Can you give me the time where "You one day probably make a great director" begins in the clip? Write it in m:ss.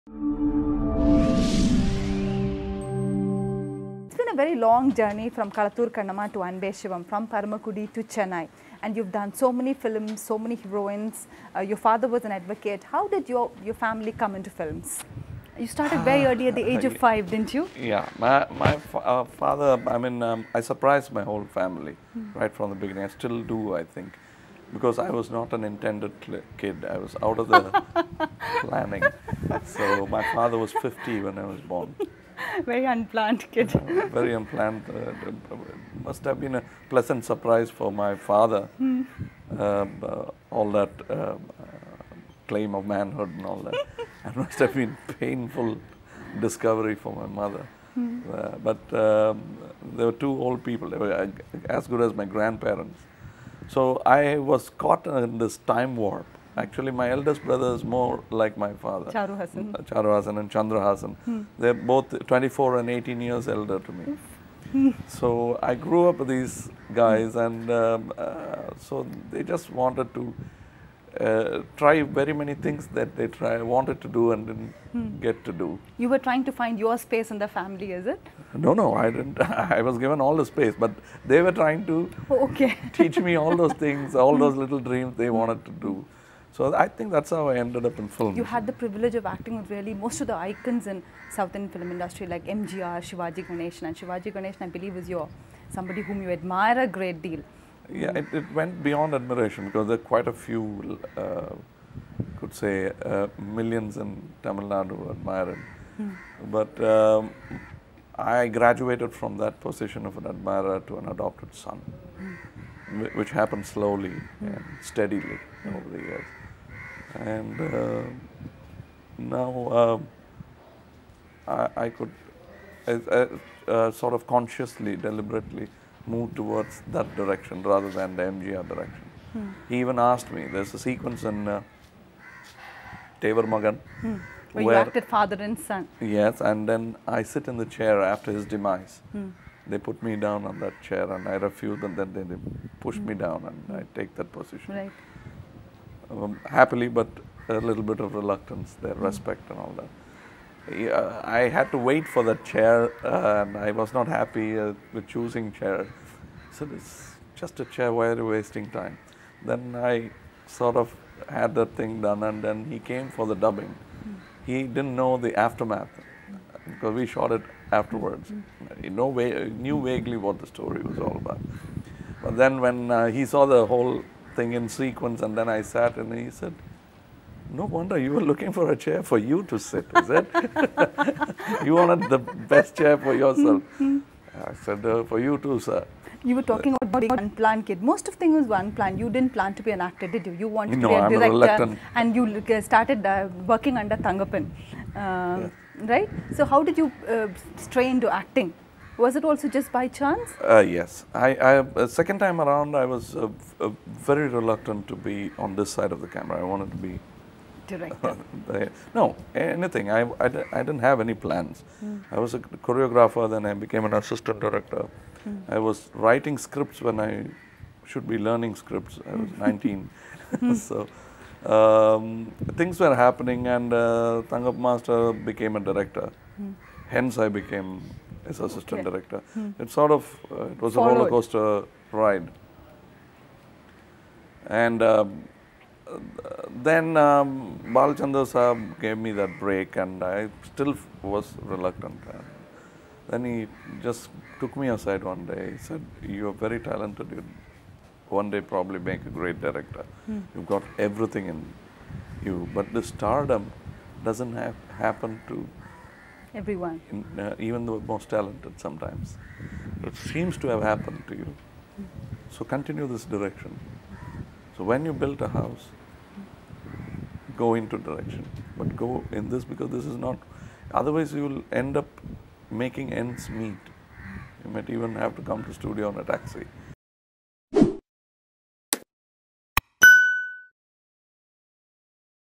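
4:07.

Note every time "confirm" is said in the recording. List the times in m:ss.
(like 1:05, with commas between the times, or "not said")
not said.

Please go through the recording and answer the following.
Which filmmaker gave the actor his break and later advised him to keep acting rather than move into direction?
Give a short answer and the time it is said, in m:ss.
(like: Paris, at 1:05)
Balachander, at 3:57.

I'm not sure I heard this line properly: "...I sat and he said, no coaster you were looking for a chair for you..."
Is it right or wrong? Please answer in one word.
wrong.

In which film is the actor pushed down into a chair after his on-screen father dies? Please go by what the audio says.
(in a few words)
Thevar Magan.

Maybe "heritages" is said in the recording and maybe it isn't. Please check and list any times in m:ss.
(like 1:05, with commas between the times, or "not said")
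not said.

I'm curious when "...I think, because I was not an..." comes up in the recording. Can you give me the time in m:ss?
0:23.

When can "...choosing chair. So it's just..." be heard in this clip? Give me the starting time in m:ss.
2:35.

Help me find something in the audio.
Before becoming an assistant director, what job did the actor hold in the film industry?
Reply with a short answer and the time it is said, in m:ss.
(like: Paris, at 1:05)
Choreographer, at 3:32.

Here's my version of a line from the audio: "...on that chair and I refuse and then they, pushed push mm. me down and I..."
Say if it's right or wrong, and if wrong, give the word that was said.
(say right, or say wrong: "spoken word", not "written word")
right.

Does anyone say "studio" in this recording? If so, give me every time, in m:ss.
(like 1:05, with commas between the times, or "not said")
4:35.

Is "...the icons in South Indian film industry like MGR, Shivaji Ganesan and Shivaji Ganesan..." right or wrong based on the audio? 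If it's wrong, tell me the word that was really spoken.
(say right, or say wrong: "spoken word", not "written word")
right.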